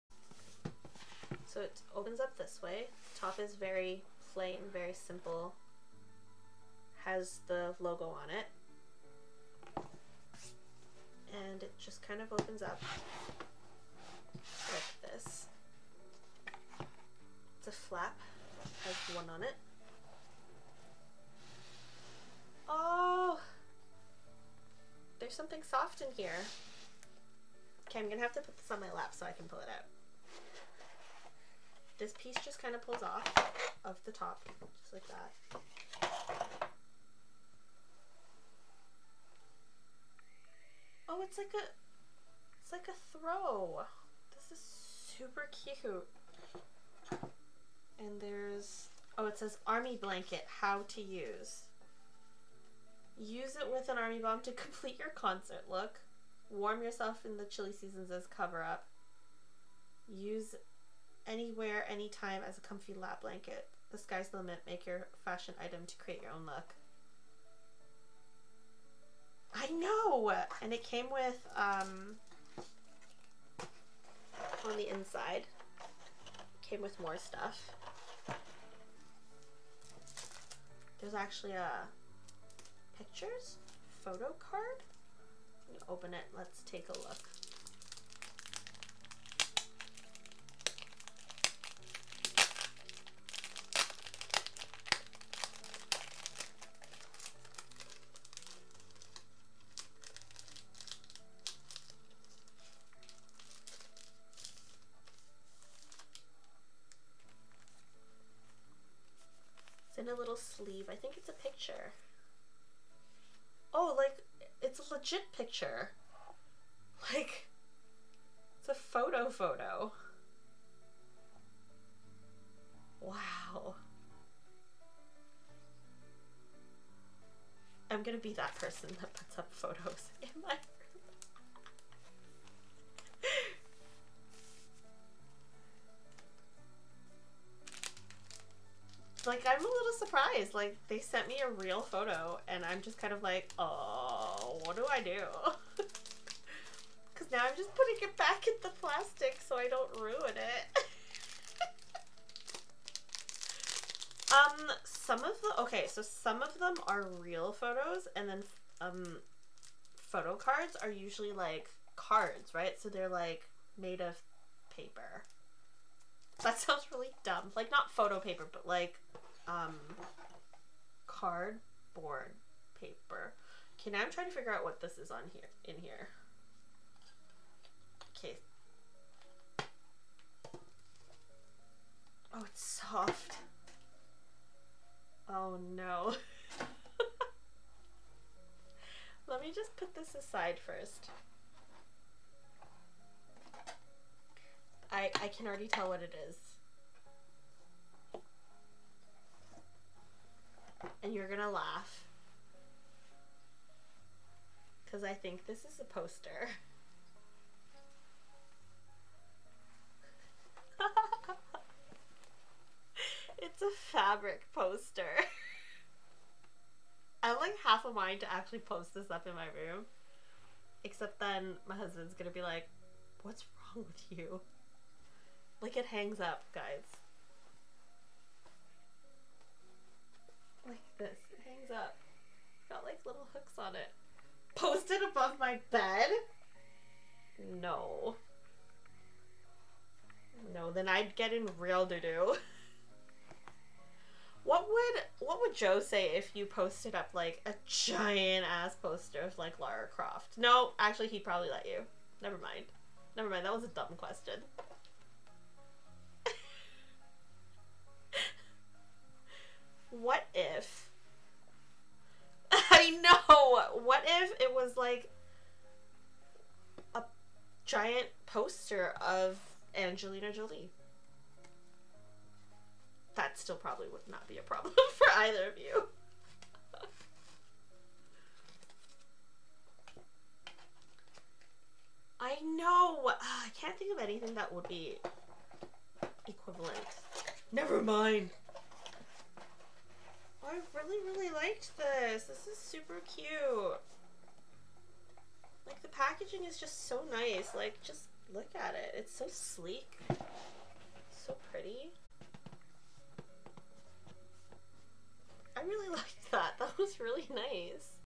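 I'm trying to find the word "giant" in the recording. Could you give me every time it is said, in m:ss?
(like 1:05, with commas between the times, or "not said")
4:07, 4:27.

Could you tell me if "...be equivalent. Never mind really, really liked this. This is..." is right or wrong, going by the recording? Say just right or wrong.
right.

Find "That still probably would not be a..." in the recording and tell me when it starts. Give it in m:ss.
4:33.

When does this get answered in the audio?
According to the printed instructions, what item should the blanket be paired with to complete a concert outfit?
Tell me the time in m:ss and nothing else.
0:53.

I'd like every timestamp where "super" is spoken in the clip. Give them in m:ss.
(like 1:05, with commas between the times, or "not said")
0:44, 4:52.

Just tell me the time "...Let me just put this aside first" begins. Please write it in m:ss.
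3:09.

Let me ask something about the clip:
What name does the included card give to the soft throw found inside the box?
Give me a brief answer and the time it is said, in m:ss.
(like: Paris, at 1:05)
army blanket, at 0:49.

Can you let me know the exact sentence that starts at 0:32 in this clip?
This piece just kind of pulls off of the top, just like that.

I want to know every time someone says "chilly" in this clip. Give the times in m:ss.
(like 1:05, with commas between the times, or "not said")
0:57.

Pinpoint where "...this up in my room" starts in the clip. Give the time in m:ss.
3:38.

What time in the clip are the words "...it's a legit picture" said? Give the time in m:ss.
1:54.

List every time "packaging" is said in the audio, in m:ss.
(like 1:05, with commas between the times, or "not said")
4:55.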